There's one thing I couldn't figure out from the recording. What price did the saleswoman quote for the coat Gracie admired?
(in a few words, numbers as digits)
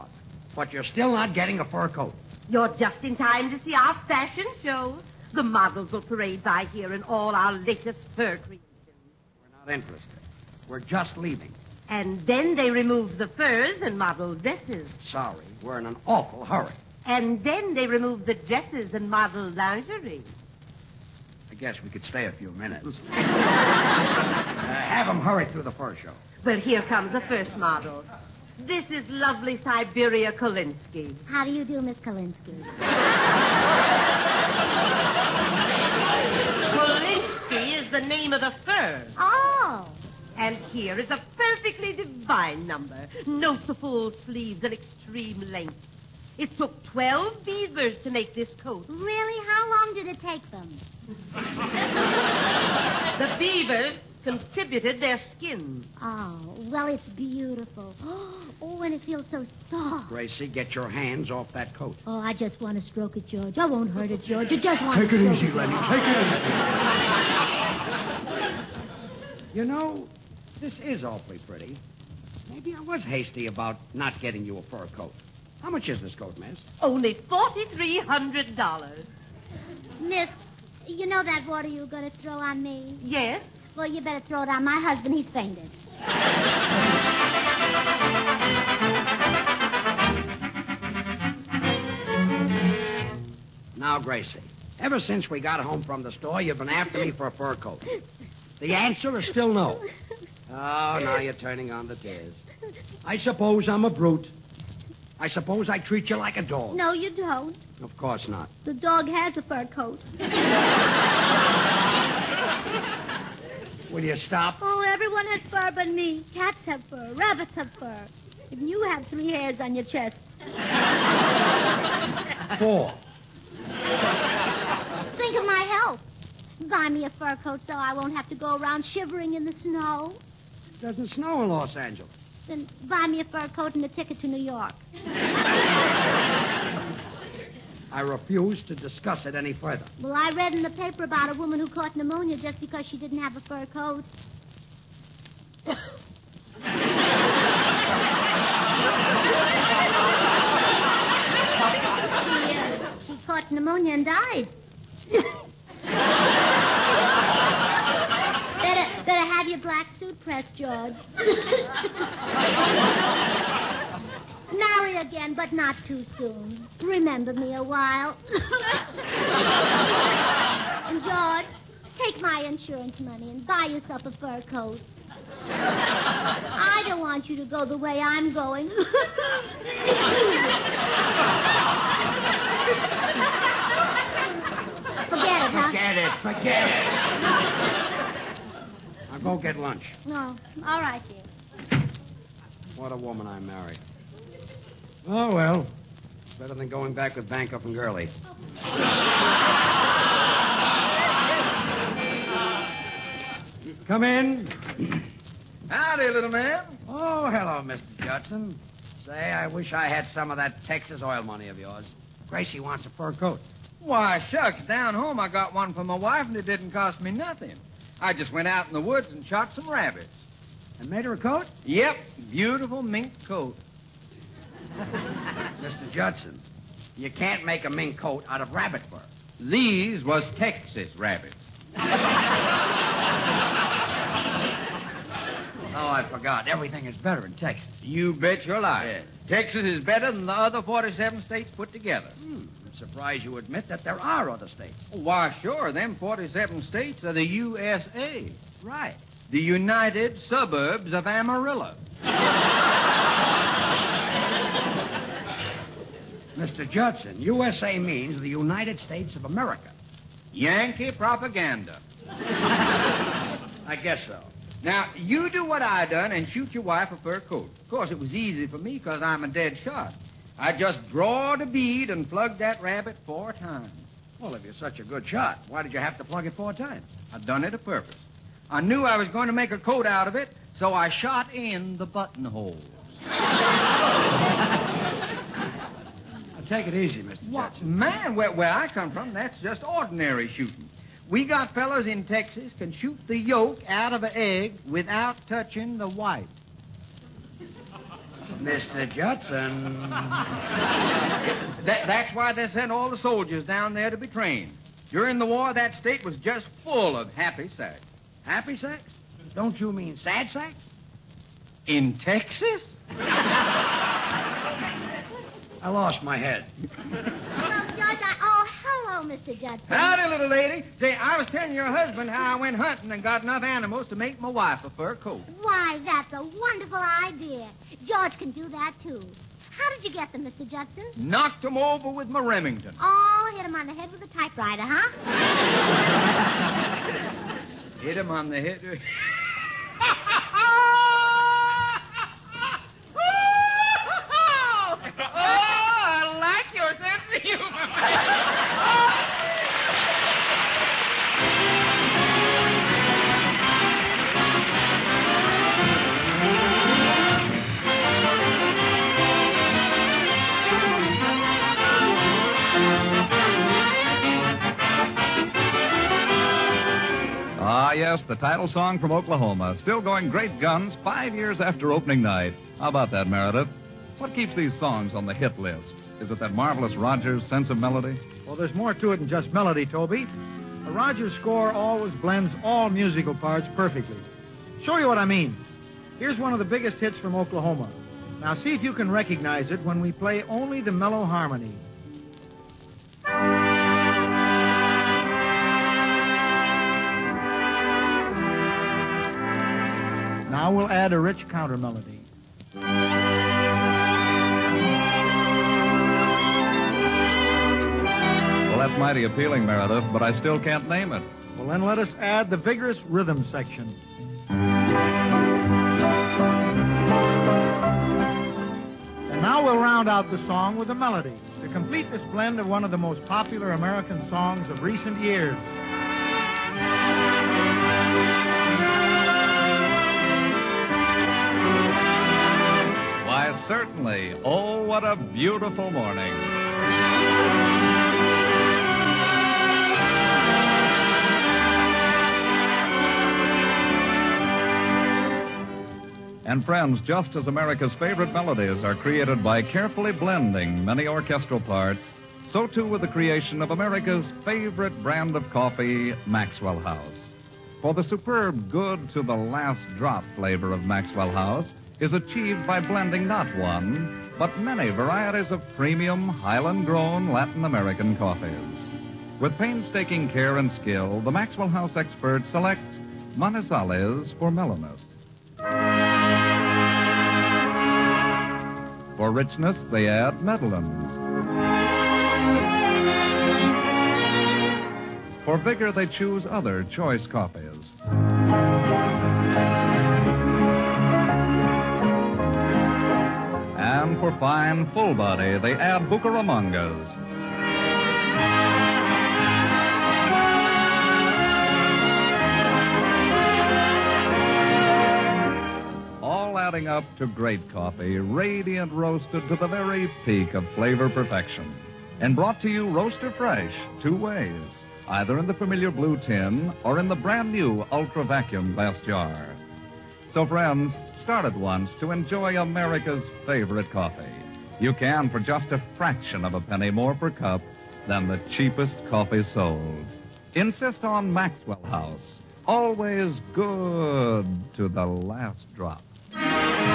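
$4,300.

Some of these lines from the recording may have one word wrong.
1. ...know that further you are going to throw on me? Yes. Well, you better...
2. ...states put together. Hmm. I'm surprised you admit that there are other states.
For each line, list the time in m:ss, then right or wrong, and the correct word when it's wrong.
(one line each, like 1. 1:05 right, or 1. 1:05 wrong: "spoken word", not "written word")
1. 1:21 wrong: "water", not "further"
2. 4:01 right.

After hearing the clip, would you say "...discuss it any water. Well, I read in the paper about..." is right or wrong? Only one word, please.
wrong.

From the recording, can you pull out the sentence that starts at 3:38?
I just went out in the woods and shot some rabbits.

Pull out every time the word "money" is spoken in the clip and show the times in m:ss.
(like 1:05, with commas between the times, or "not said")
2:52, 3:31.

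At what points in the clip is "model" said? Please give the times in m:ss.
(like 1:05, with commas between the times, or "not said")
0:05, 0:13, 0:19, 0:27.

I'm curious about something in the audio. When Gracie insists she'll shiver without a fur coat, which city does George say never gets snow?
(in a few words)
Los Angeles.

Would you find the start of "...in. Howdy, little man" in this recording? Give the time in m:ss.
3:24.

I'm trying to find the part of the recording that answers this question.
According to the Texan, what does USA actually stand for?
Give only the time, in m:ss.
4:09.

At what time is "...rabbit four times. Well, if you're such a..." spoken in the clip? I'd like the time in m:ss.
4:32.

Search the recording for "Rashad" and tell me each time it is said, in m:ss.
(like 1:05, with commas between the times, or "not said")
not said.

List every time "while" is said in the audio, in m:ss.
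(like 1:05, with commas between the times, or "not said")
2:47.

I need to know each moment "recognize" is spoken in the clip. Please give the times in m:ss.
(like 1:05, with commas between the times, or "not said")
6:28.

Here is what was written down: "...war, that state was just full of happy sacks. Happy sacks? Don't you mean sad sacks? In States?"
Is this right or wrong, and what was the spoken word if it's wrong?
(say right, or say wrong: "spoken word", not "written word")
wrong: "Texas", not "States".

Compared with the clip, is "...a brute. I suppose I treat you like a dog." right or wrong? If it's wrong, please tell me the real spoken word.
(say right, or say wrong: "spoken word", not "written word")
right.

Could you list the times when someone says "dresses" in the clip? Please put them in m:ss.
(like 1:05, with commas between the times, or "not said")
0:14, 0:18.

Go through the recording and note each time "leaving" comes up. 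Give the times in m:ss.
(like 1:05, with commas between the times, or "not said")
0:11.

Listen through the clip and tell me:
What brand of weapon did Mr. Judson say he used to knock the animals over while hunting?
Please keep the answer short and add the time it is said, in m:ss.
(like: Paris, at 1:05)
Remington, at 5:32.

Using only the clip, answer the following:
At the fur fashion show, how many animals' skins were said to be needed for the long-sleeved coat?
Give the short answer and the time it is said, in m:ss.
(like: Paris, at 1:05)
12, at 0:46.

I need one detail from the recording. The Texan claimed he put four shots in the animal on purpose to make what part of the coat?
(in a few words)
Buttonholes.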